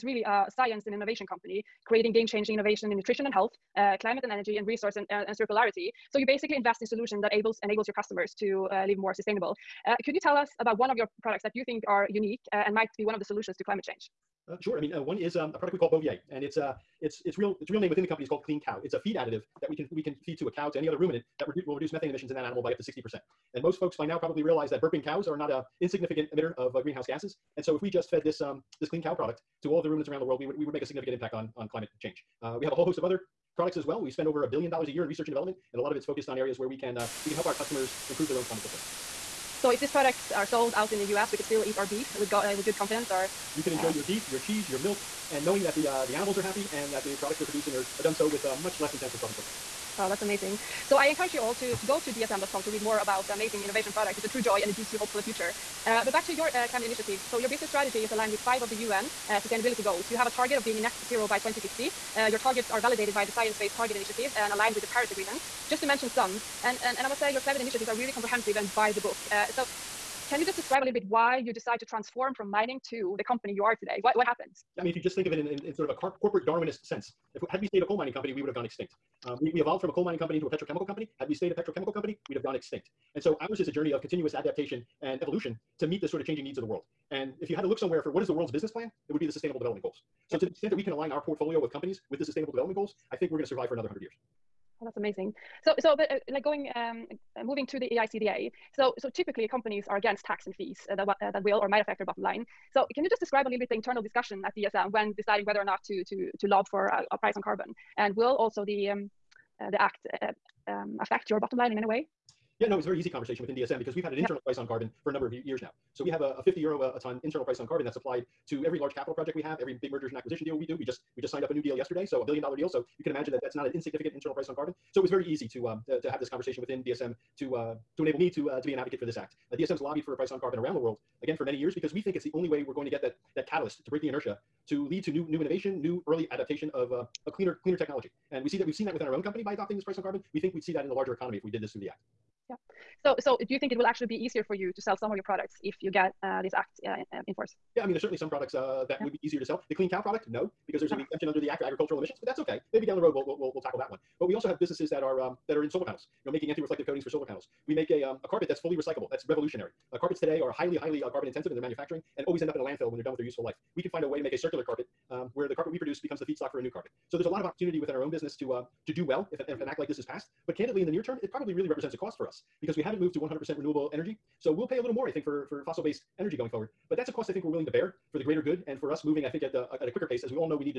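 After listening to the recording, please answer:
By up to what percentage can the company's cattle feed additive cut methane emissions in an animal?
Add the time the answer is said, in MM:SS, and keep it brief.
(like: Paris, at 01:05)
60%, at 00:22.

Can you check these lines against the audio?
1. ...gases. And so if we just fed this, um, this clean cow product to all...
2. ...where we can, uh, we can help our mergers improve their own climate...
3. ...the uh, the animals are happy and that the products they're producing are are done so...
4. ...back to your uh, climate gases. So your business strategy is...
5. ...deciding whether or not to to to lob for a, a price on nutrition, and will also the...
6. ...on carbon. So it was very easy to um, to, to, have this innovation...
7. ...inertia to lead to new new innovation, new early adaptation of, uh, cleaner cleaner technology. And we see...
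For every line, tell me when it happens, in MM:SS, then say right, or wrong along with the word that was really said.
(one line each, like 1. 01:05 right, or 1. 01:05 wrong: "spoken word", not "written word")
1. 00:27 right
2. 00:36 wrong: "customers", not "mergers"
3. 00:45 right
4. 00:56 wrong: "initiatives", not "gases"
5. 01:45 wrong: "carbon", not "nutrition"
6. 02:04 wrong: "conversation", not "innovation"
7. 02:14 right.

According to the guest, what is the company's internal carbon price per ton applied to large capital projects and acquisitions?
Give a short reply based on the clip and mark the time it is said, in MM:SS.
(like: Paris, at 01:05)
50 euros, at 01:56.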